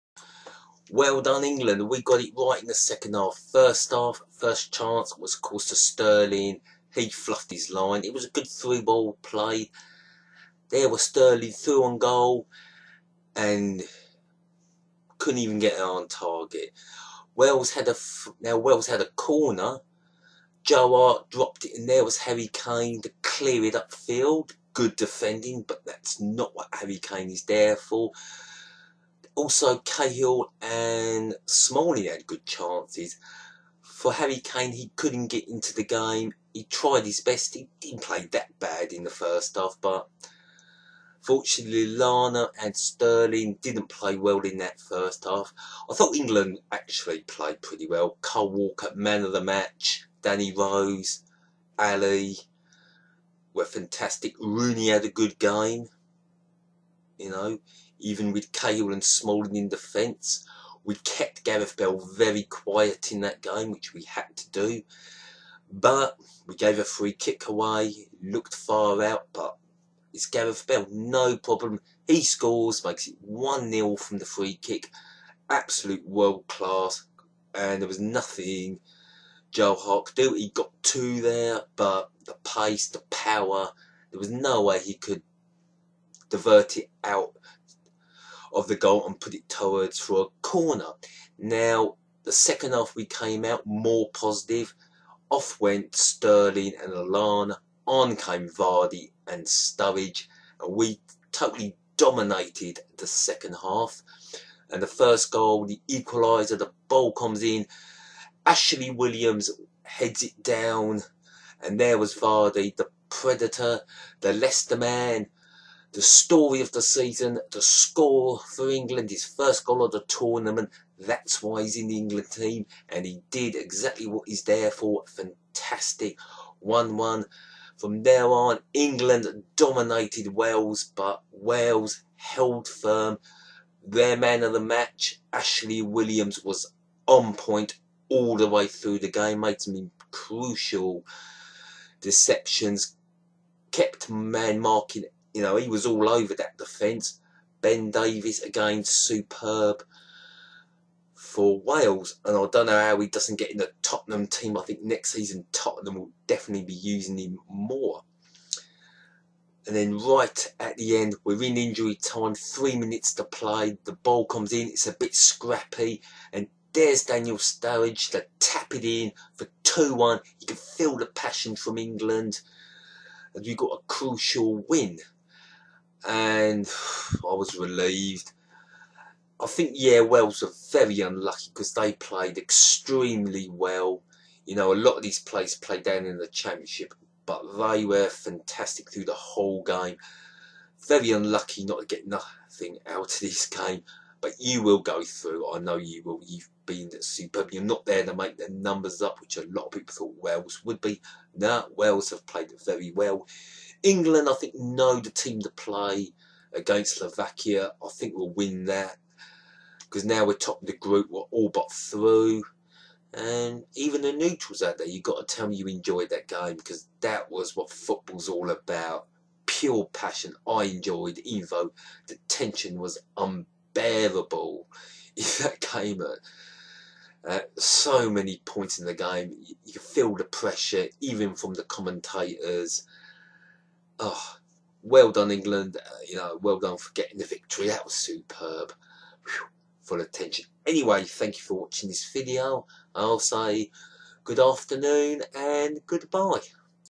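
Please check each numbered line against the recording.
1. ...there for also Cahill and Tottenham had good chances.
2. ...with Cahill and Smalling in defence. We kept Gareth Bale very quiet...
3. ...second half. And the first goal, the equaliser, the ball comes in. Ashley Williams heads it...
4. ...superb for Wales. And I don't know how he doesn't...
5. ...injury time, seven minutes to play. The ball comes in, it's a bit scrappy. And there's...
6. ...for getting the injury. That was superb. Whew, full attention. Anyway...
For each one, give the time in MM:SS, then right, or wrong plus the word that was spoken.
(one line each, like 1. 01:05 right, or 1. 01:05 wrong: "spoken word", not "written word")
1. 00:27 wrong: "Smalling", not "Tottenham"
2. 00:58 right
3. 01:43 right
4. 02:28 right
5. 02:41 wrong: "three", not "seven"
6. 03:56 wrong: "victory", not "injury".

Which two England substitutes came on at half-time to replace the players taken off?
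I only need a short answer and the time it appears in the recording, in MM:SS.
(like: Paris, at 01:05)
Vardy and Sturridge, at 01:38.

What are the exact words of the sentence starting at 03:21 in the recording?
No, Wales have played very well.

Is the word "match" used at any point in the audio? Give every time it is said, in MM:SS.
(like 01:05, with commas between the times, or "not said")
00:49, 02:14.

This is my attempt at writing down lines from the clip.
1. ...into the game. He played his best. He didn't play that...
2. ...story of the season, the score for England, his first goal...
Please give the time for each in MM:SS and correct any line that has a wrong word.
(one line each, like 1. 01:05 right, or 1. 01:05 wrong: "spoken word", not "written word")
1. 00:35 wrong: "tried", not "played"
2. 01:56 right.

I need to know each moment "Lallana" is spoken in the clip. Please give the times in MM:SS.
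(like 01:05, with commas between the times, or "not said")
00:41, 01:36.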